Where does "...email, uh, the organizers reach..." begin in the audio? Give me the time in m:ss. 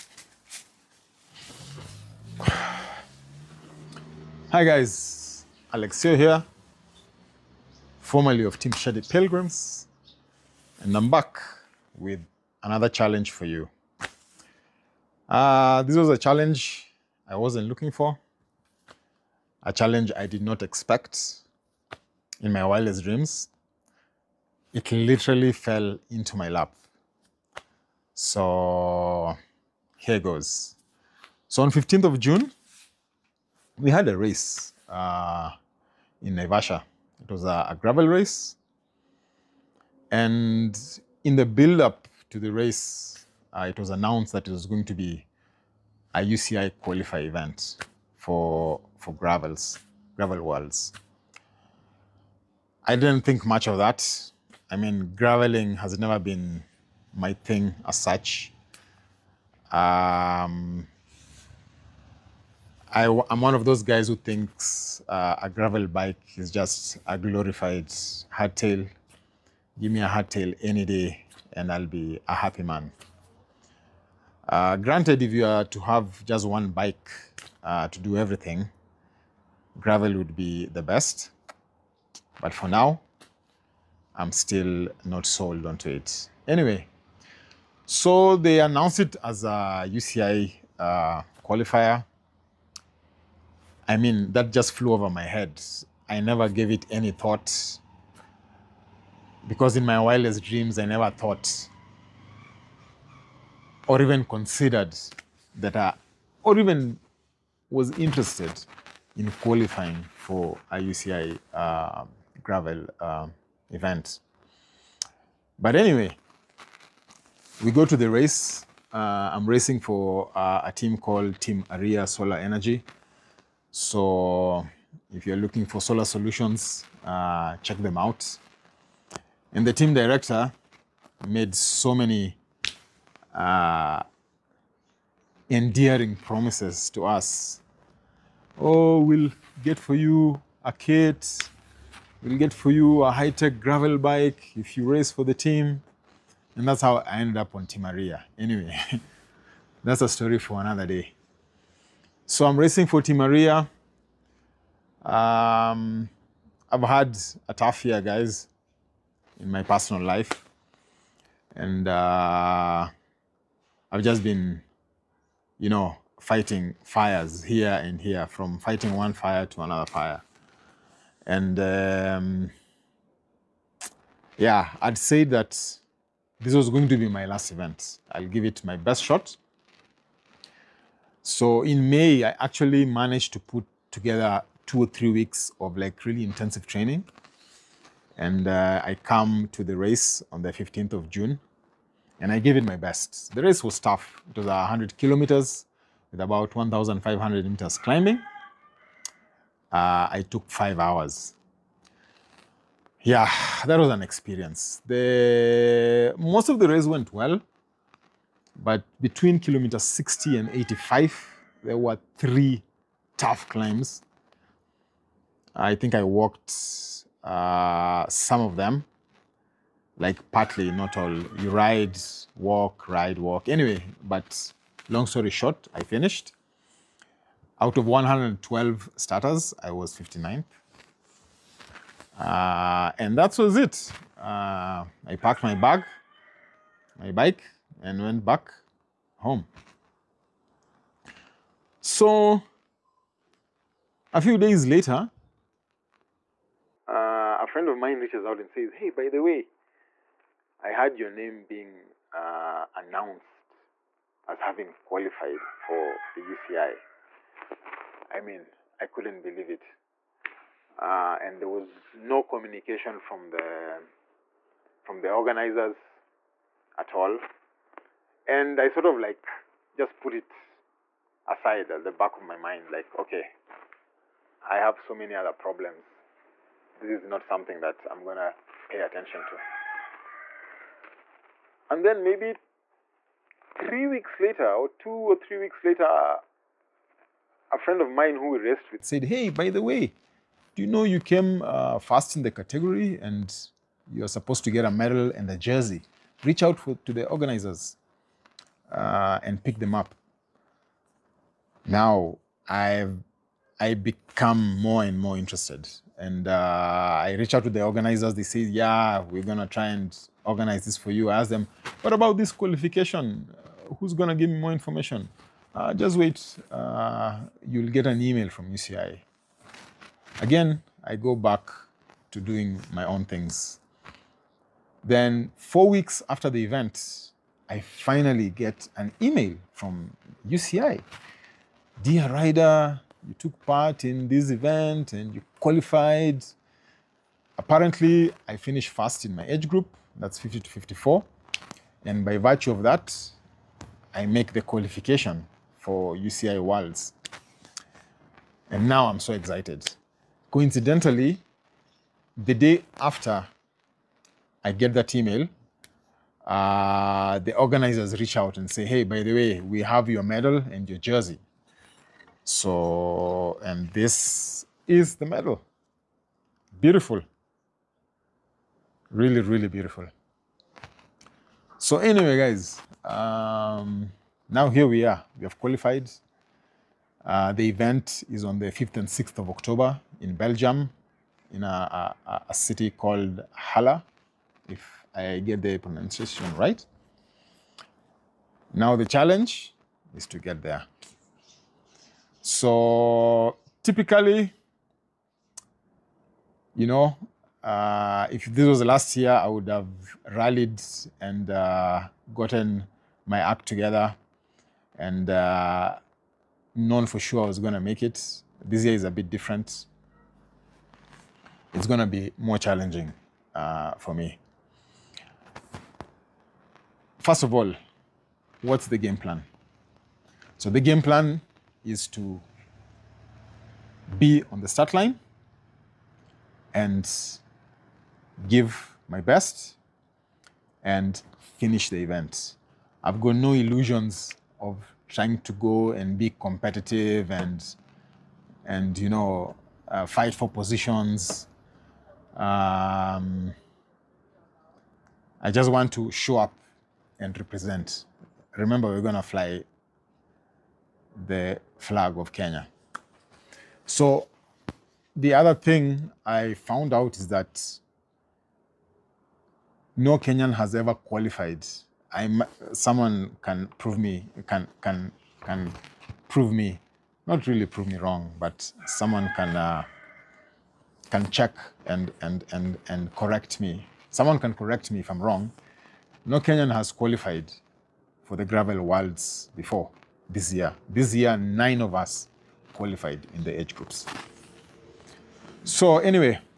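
5:54.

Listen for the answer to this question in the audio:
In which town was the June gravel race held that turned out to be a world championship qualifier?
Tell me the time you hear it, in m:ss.
0:36.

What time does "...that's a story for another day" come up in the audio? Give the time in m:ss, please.
2:29.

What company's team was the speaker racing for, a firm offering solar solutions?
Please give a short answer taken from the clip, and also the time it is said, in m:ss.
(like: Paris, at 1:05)
Team Aria Solar Energy, at 2:01.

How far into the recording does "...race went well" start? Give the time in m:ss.
3:26.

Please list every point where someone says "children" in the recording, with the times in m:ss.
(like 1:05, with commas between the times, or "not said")
not said.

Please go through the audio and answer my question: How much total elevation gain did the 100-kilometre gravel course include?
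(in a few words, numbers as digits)
1,500 meters.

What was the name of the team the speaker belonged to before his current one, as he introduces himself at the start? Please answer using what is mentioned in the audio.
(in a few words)
Team Shady Pilgrims.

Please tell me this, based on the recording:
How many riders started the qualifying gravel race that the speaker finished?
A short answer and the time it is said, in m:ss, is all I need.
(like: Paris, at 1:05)
112, at 3:47.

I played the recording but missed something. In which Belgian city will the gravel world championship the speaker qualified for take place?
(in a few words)
Halle.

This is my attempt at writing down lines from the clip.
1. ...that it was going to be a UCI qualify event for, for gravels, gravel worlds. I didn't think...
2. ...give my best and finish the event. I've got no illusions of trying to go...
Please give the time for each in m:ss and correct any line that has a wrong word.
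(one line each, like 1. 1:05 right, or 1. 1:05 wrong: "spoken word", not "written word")
1. 0:44 right
2. 7:08 right.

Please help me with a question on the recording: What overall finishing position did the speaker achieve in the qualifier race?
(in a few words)
59th.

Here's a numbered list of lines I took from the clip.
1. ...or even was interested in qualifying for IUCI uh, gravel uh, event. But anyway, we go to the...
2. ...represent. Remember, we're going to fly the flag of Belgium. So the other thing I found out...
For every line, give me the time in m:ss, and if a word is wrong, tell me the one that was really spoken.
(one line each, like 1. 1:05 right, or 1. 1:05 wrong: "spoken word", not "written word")
1. 1:46 right
2. 7:27 wrong: "Kenya", not "Belgium".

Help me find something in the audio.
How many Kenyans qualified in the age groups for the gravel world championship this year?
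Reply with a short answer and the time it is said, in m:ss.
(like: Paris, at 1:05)
9, at 8:01.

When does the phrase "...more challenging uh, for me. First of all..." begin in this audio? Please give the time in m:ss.
6:52.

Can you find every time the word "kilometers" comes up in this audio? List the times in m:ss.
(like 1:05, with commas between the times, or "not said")
3:14, 3:29.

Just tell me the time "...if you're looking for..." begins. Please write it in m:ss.
2:05.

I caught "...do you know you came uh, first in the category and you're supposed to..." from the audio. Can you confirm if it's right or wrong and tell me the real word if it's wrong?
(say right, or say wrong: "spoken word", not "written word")
right.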